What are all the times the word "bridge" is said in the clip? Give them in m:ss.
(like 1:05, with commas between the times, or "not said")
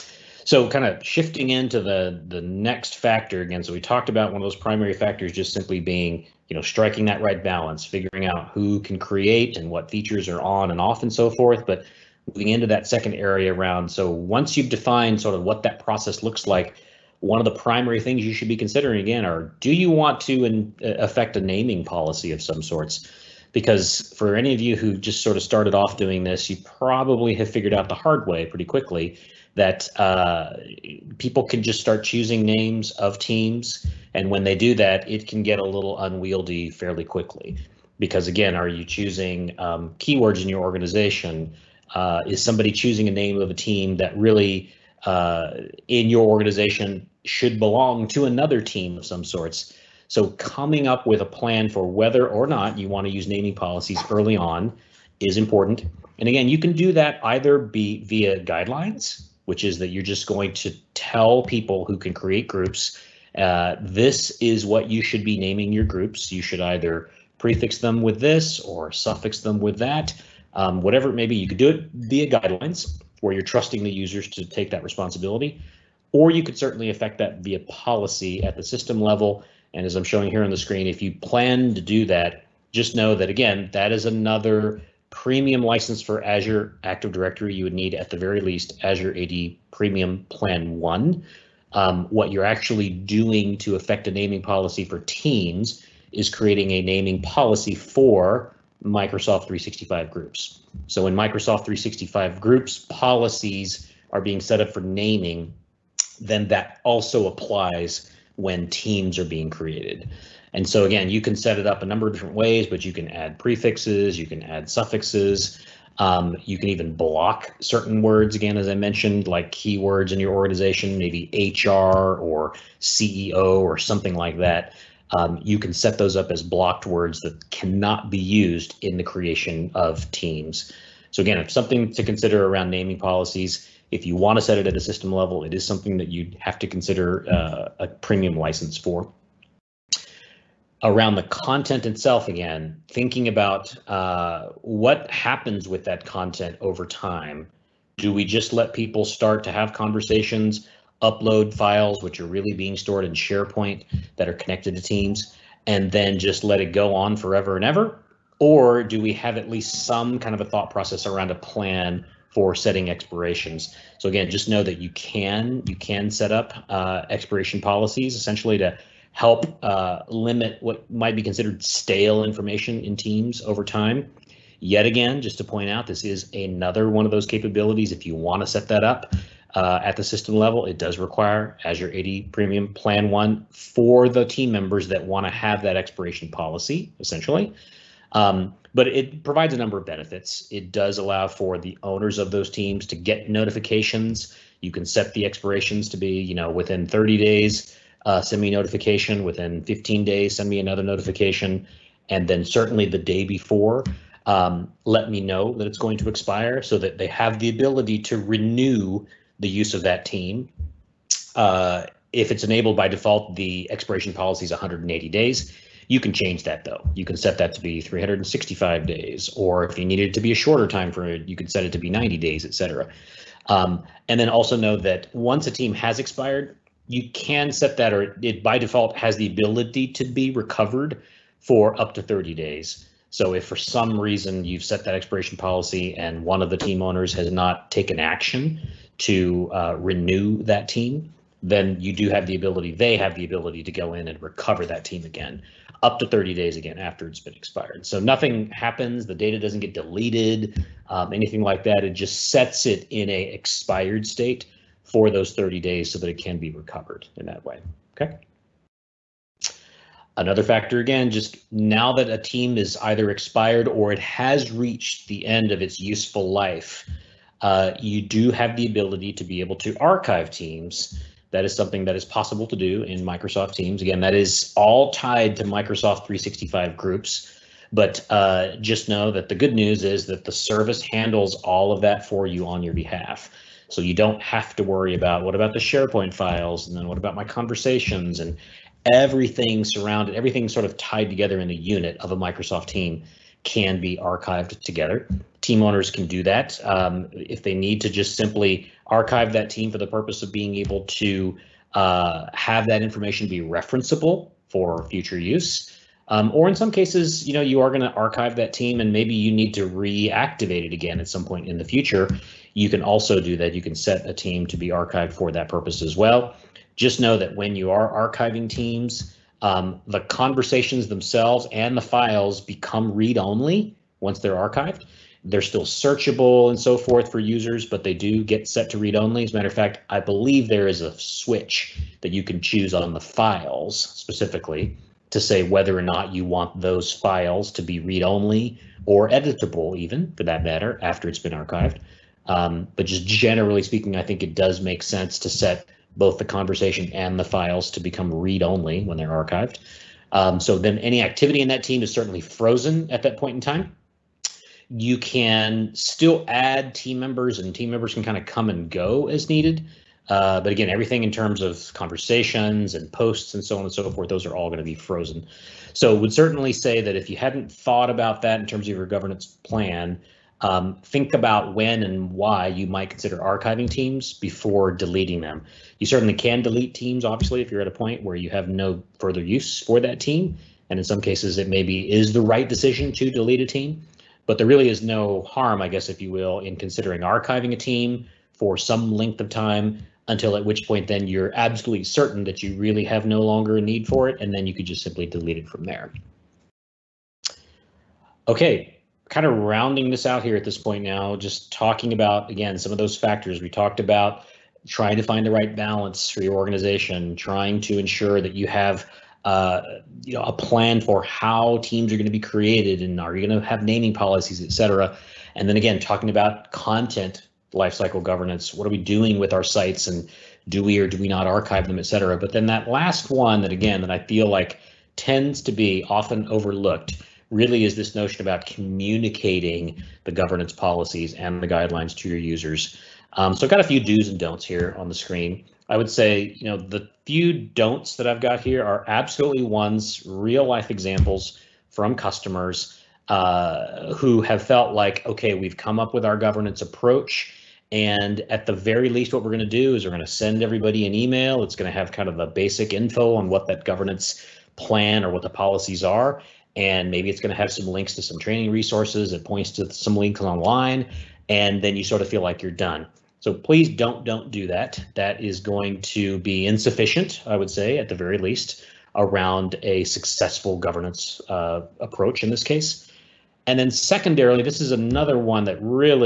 not said.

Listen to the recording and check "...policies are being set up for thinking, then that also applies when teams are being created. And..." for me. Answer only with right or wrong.
wrong.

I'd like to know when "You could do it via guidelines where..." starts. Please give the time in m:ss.
1:11.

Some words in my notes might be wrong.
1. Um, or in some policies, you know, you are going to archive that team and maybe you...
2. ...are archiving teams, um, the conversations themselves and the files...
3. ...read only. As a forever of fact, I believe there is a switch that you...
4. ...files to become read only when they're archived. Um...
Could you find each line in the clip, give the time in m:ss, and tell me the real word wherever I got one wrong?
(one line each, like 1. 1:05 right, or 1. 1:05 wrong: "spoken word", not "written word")
1. 5:06 wrong: "cases", not "policies"
2. 5:17 right
3. 5:28 wrong: "matter", not "forever"
4. 5:47 right.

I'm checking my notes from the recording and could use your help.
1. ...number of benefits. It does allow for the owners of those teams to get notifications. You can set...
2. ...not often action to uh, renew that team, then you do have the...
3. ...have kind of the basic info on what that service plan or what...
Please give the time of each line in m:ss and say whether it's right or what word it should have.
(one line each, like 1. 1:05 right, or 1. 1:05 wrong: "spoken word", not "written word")
1. 3:09 right
2. 3:57 wrong: "taken", not "often"
3. 7:31 wrong: "governance", not "service".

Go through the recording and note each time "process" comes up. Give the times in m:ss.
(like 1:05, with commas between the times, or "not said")
0:15, 2:40.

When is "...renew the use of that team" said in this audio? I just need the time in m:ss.
3:28.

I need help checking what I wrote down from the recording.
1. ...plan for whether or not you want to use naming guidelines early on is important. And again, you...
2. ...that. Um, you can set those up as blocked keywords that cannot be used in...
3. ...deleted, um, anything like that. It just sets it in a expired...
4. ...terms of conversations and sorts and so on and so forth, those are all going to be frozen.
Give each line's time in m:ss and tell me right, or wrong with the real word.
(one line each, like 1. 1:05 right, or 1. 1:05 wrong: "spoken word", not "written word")
1. 0:51 wrong: "policies", not "guidelines"
2. 2:04 wrong: "words", not "keywords"
3. 4:09 right
4. 6:01 wrong: "posts", not "sorts".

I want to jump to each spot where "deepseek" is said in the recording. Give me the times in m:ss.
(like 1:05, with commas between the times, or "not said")
not said.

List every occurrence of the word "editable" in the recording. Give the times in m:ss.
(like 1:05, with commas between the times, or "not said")
5:39.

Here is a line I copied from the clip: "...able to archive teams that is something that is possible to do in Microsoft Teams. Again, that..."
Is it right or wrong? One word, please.
right.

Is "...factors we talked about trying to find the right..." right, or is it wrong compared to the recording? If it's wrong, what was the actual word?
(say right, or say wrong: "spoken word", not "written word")
right.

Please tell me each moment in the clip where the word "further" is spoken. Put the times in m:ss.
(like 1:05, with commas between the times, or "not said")
6:18.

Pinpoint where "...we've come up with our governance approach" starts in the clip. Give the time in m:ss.
7:25.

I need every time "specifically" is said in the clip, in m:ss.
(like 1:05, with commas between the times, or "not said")
5:33.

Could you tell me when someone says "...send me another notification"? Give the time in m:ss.
3:20.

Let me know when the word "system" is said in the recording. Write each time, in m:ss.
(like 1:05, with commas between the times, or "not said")
1:18, 2:14, 3:00.